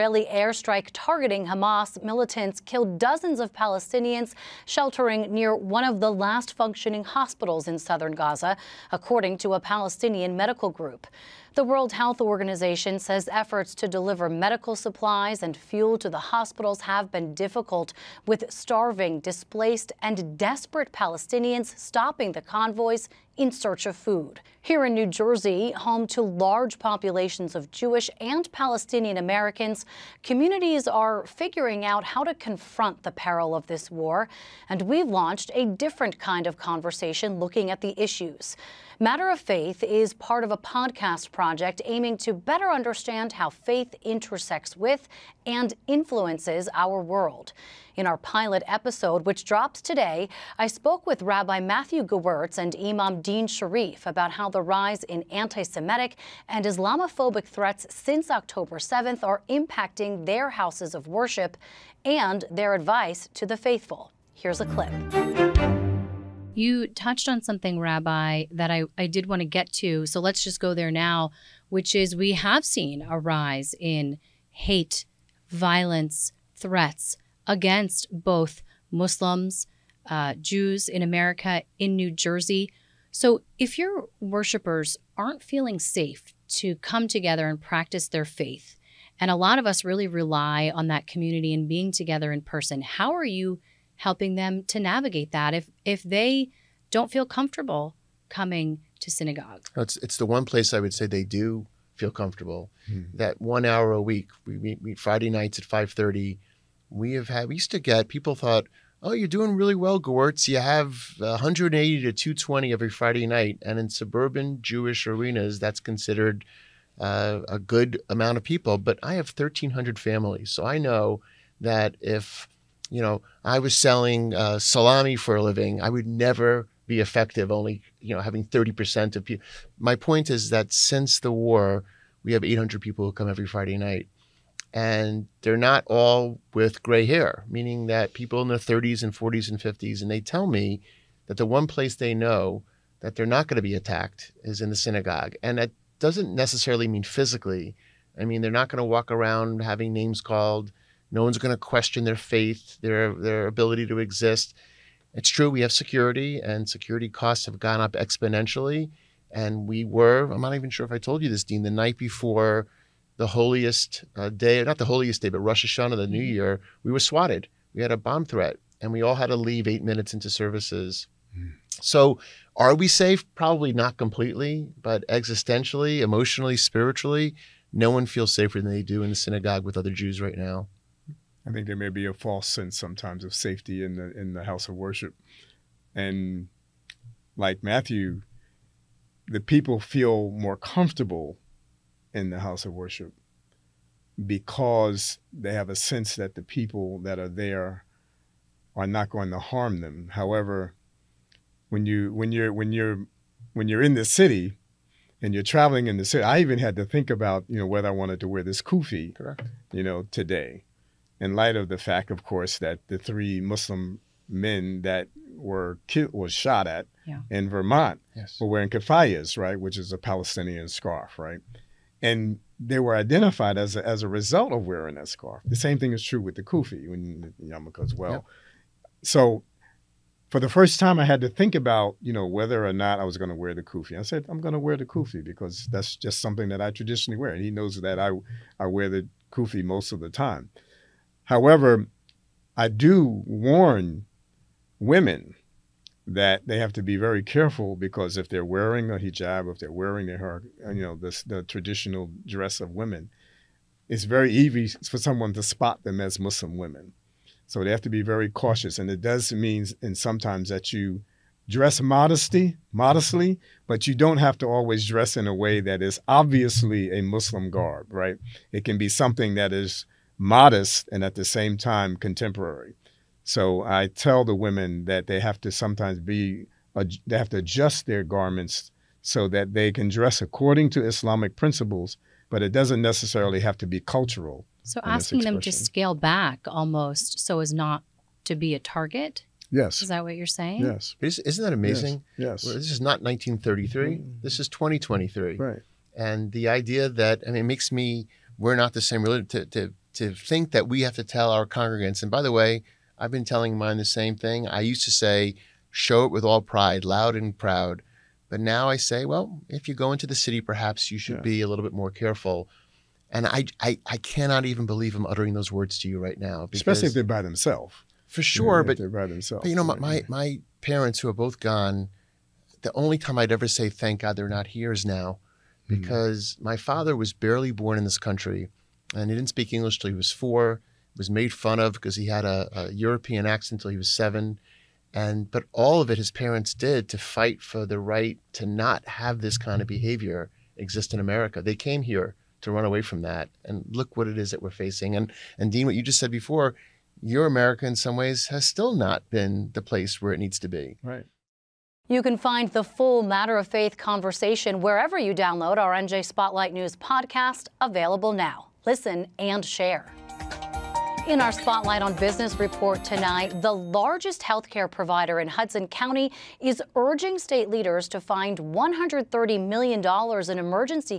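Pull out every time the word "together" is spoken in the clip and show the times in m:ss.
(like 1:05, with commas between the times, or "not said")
1:27, 1:31.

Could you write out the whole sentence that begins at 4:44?
So asking them to scale back almost so as not to be a target?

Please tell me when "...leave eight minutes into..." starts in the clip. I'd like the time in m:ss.
2:49.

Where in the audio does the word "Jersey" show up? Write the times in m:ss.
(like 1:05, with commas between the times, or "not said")
0:25, 1:22.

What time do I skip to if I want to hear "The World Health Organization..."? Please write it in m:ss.
0:11.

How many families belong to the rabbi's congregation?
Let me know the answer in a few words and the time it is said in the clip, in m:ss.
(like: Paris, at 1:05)
1,300, at 1:59.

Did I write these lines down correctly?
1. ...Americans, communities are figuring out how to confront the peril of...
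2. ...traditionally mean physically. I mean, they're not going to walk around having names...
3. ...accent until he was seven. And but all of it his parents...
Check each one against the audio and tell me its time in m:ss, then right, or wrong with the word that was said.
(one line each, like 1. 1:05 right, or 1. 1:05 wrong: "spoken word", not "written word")
1. 0:29 right
2. 2:26 wrong: "necessarily", not "traditionally"
3. 5:33 right.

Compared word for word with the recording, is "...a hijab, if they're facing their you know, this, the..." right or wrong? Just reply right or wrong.
wrong.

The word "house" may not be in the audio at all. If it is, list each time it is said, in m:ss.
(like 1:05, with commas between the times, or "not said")
1:00, 3:04, 3:12.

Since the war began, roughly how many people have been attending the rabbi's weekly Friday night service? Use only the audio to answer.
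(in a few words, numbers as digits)
800.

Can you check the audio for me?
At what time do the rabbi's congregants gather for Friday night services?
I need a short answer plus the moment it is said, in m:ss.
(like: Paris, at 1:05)
5:30, at 1:45.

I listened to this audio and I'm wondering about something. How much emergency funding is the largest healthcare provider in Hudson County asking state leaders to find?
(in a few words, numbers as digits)
$130 million.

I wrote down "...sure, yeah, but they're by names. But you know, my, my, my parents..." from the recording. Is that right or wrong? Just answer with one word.
wrong.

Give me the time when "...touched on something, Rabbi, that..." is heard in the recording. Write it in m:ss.
1:06.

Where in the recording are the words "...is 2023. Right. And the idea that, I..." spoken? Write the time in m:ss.
4:54.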